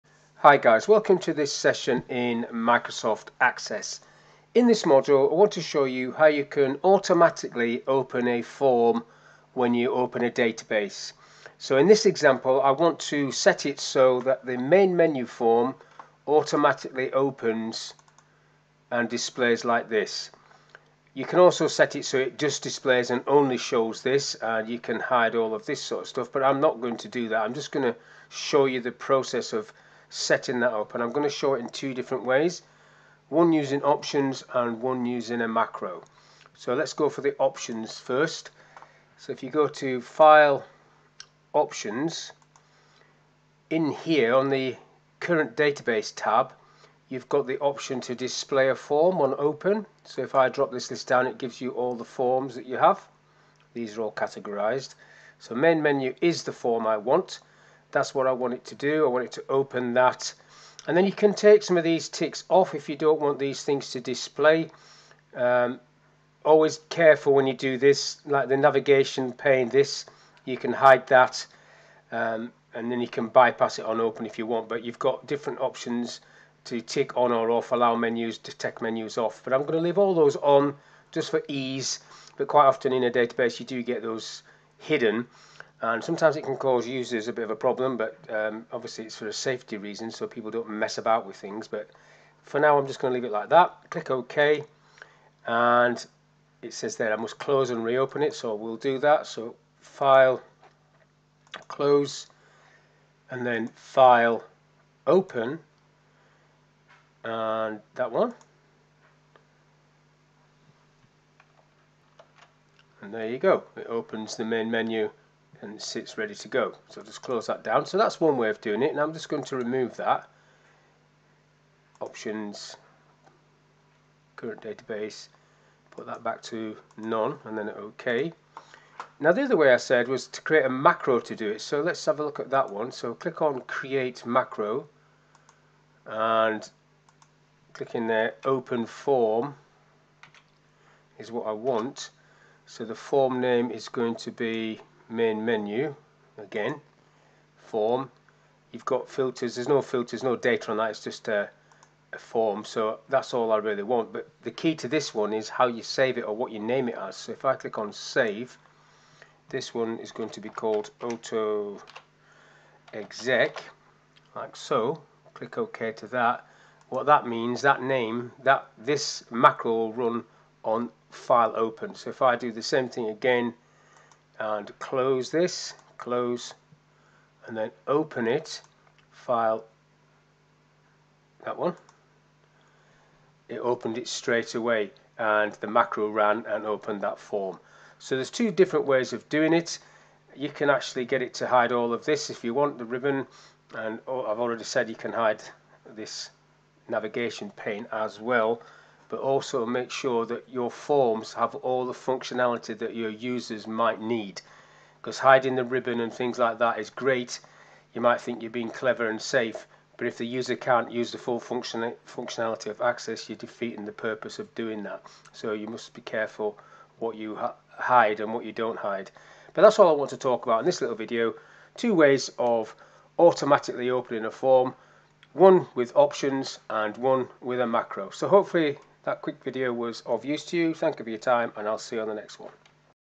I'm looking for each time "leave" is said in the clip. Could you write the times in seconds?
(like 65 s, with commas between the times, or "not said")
79 s, 93 s.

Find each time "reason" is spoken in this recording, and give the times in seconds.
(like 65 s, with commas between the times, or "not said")
89 s.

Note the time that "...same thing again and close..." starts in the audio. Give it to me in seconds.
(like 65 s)
172 s.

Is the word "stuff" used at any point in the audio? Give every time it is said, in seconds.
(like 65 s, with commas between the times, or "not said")
26 s.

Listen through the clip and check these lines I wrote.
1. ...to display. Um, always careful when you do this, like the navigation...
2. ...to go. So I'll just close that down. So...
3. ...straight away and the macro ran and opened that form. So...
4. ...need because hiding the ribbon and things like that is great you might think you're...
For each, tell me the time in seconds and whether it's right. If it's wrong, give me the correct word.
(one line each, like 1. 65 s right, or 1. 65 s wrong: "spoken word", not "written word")
1. 63 s right
2. 116 s right
3. 184 s right
4. 203 s right.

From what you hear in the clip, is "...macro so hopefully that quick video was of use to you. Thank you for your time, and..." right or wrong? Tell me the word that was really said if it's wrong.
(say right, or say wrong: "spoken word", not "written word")
right.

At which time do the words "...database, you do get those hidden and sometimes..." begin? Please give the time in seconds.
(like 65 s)
83 s.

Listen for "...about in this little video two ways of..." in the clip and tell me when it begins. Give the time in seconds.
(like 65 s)
220 s.